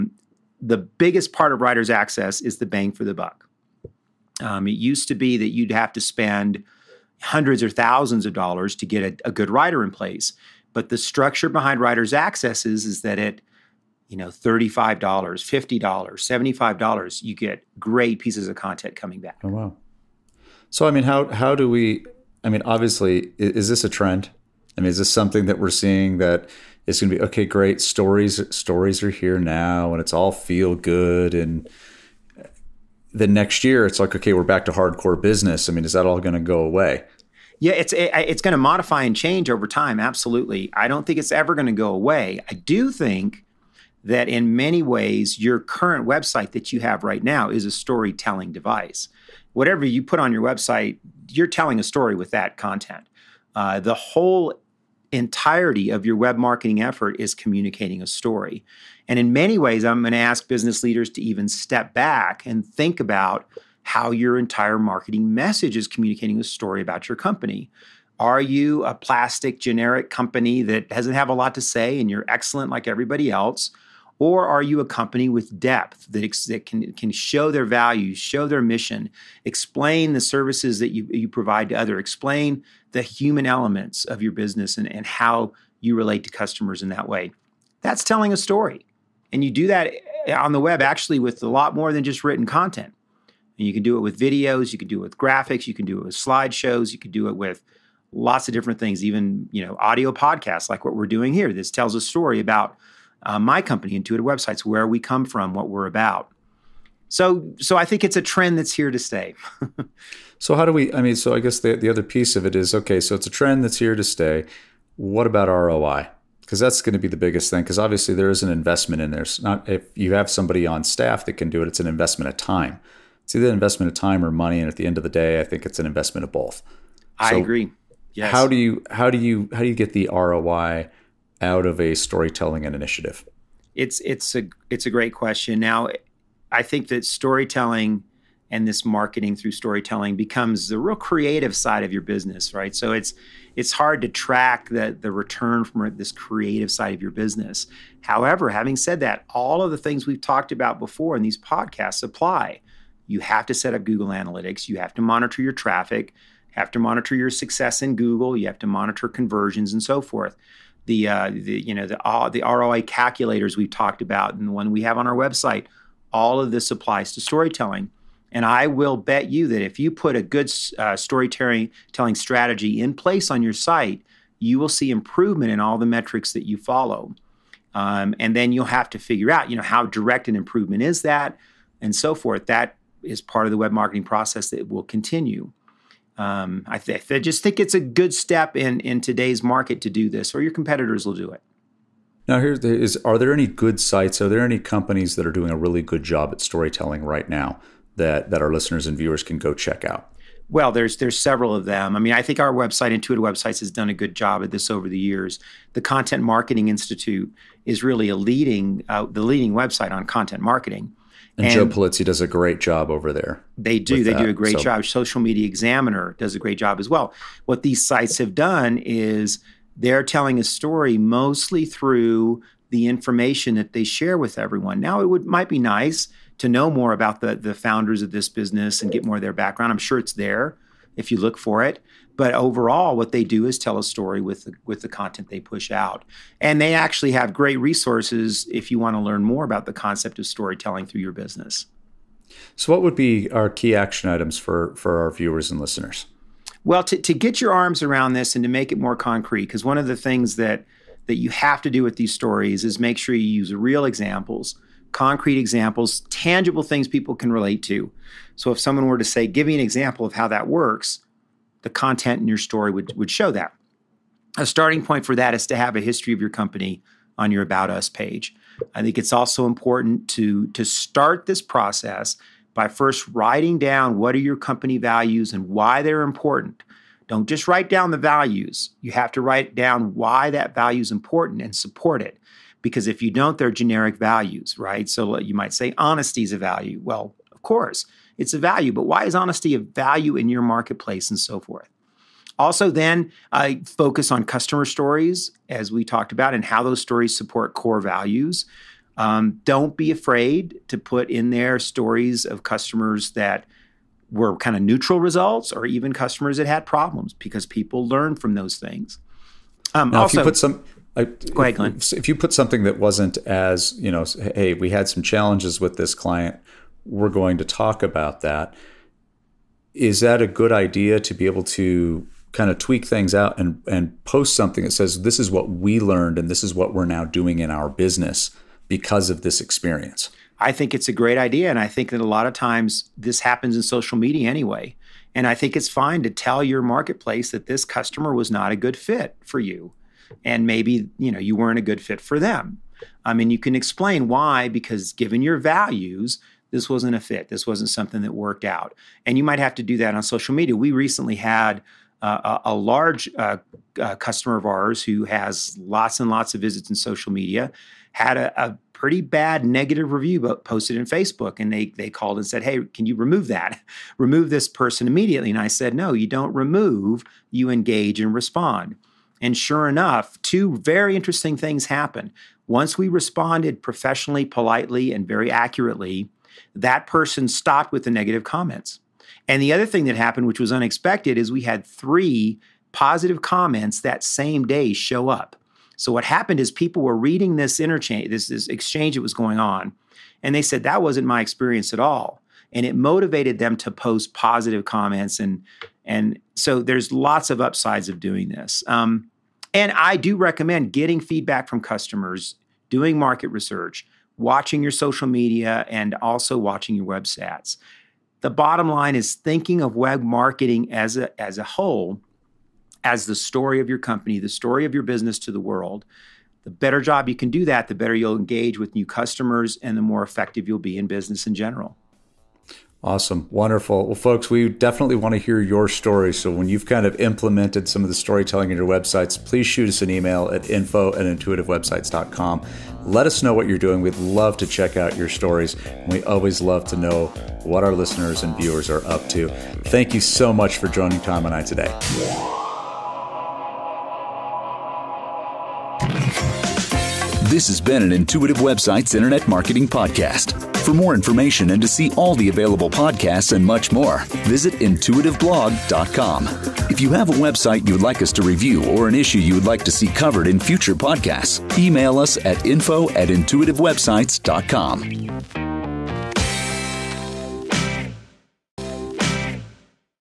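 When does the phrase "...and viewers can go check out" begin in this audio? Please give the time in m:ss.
3:18.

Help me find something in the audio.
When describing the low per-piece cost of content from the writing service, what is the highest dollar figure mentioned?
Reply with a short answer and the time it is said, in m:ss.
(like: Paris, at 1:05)
$75, at 0:15.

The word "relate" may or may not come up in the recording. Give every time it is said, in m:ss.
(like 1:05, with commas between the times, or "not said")
1:25, 4:17.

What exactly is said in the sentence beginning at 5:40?
And maybe, you know, you weren't a good fit for them.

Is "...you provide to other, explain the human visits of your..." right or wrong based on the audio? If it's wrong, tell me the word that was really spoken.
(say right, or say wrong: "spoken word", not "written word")
wrong: "elements", not "visits".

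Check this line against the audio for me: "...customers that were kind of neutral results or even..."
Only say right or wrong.
right.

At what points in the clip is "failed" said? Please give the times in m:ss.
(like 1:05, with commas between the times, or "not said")
not said.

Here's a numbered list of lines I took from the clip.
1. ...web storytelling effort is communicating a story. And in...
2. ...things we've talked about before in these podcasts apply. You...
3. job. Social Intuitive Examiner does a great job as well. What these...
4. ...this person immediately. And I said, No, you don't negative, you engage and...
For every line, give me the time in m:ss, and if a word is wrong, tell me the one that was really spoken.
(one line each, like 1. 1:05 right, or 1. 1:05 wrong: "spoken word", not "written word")
1. 0:56 wrong: "marketing", not "storytelling"
2. 2:29 right
3. 3:34 wrong: "Media", not "Intuitive"
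4. 6:04 wrong: "remove", not "negative".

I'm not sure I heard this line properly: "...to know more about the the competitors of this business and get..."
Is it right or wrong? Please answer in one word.
wrong.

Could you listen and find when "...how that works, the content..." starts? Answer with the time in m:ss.
4:20.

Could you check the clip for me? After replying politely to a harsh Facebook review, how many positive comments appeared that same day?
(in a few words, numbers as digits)
3.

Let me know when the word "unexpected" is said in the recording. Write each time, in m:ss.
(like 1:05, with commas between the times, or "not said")
6:20.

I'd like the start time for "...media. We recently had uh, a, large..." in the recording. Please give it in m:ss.
5:50.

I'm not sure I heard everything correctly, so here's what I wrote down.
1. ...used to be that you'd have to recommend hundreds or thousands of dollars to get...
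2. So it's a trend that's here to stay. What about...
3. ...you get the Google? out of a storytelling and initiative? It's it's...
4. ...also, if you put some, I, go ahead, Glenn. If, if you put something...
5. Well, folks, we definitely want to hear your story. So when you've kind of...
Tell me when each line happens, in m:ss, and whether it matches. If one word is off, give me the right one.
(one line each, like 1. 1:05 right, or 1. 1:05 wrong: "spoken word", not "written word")
1. 0:04 wrong: "spend", not "recommend"
2. 1:52 right
3. 2:09 wrong: "ROI", not "Google"
4. 5:10 right
5. 7:03 right.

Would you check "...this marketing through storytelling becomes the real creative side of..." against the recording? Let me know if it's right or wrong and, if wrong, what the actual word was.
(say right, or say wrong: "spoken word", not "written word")
right.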